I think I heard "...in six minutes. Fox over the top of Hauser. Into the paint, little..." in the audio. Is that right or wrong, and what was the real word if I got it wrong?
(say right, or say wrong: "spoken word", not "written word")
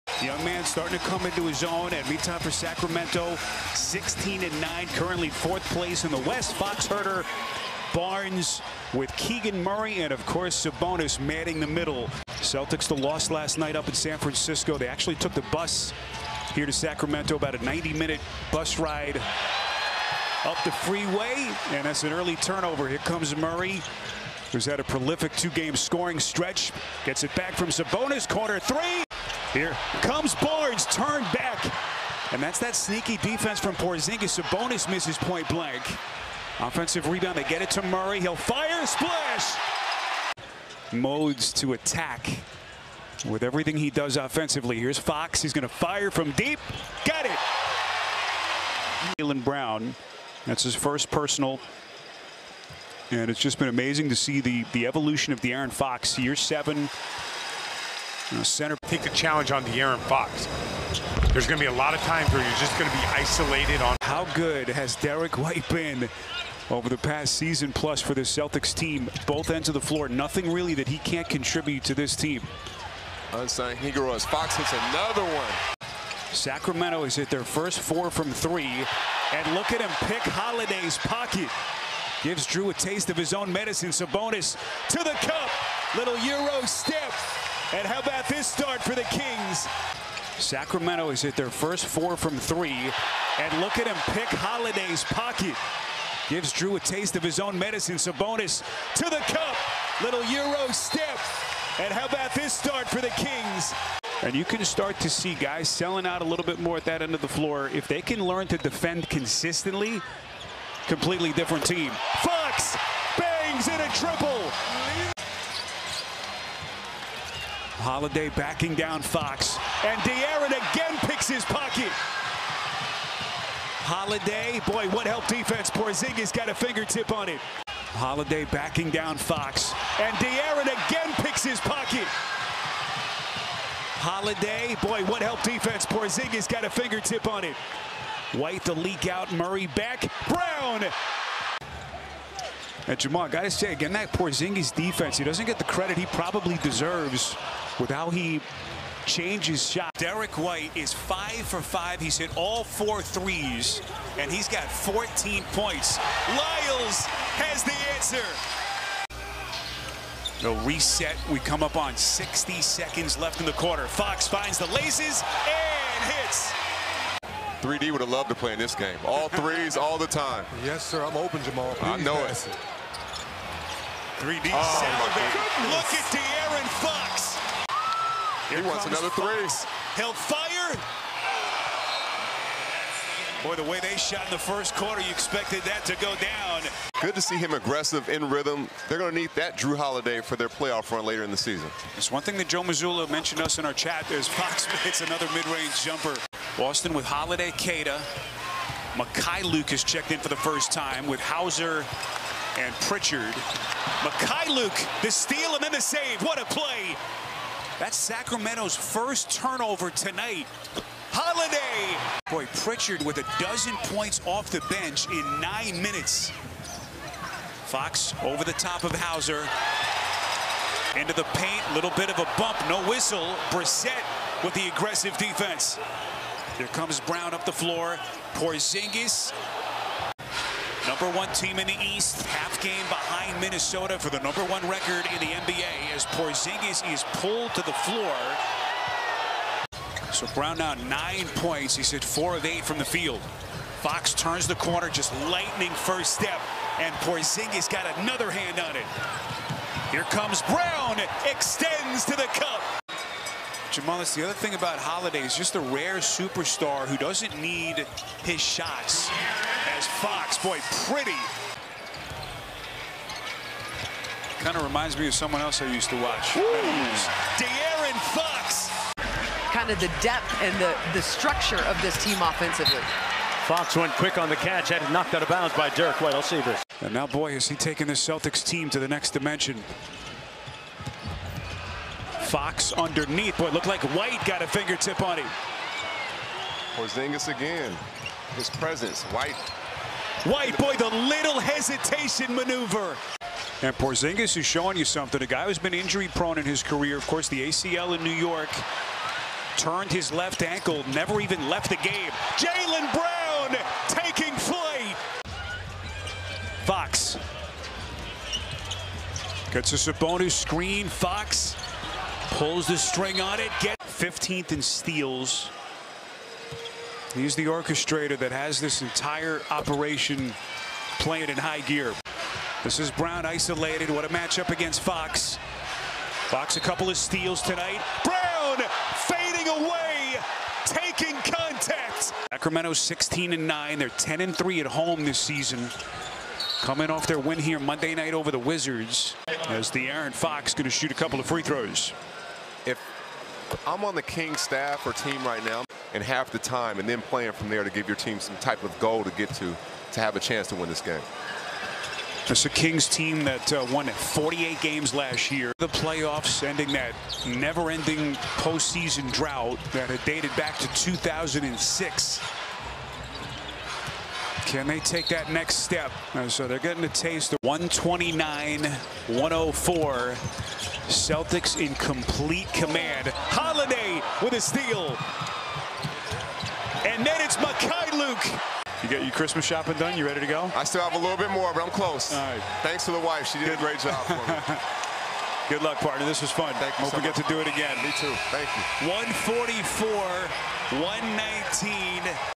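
wrong: "nine", not "six".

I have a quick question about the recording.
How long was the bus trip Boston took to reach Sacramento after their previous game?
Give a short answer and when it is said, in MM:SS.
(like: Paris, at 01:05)
90 minutes, at 00:17.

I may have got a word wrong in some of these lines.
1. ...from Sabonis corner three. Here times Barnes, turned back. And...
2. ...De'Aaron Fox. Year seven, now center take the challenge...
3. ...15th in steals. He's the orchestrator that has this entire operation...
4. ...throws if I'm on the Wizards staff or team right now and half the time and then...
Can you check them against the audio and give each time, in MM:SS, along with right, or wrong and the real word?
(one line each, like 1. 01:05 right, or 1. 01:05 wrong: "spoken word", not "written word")
1. 00:27 wrong: "comes", not "times"
2. 00:55 right
3. 05:13 right
4. 05:41 wrong: "King", not "Wizards".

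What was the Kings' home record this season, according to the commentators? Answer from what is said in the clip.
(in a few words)
10 and 3.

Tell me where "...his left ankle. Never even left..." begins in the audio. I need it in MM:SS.
04:59.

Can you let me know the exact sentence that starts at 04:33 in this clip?
Fox went quick on the catch, had it knocked out of bounds by Derrick White.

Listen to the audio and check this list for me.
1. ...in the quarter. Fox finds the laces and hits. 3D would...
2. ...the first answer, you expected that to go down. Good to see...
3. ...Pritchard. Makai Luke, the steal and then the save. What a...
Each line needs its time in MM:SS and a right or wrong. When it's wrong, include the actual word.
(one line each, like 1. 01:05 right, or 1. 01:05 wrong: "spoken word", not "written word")
1. 02:43 right
2. 03:04 wrong: "quarter", not "answer"
3. 03:22 right.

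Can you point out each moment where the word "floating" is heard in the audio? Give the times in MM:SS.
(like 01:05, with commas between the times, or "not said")
not said.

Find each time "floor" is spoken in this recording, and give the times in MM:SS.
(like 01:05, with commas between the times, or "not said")
01:09, 01:47, 03:47, 03:57.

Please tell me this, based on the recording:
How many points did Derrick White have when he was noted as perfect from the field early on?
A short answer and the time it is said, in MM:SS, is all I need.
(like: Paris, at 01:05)
14, at 02:34.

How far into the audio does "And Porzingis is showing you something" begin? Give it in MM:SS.
04:53.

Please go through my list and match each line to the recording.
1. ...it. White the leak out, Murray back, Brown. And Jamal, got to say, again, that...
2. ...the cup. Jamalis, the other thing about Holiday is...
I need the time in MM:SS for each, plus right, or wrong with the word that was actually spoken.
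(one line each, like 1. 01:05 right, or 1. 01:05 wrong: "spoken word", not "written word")
1. 02:17 right
2. 04:12 right.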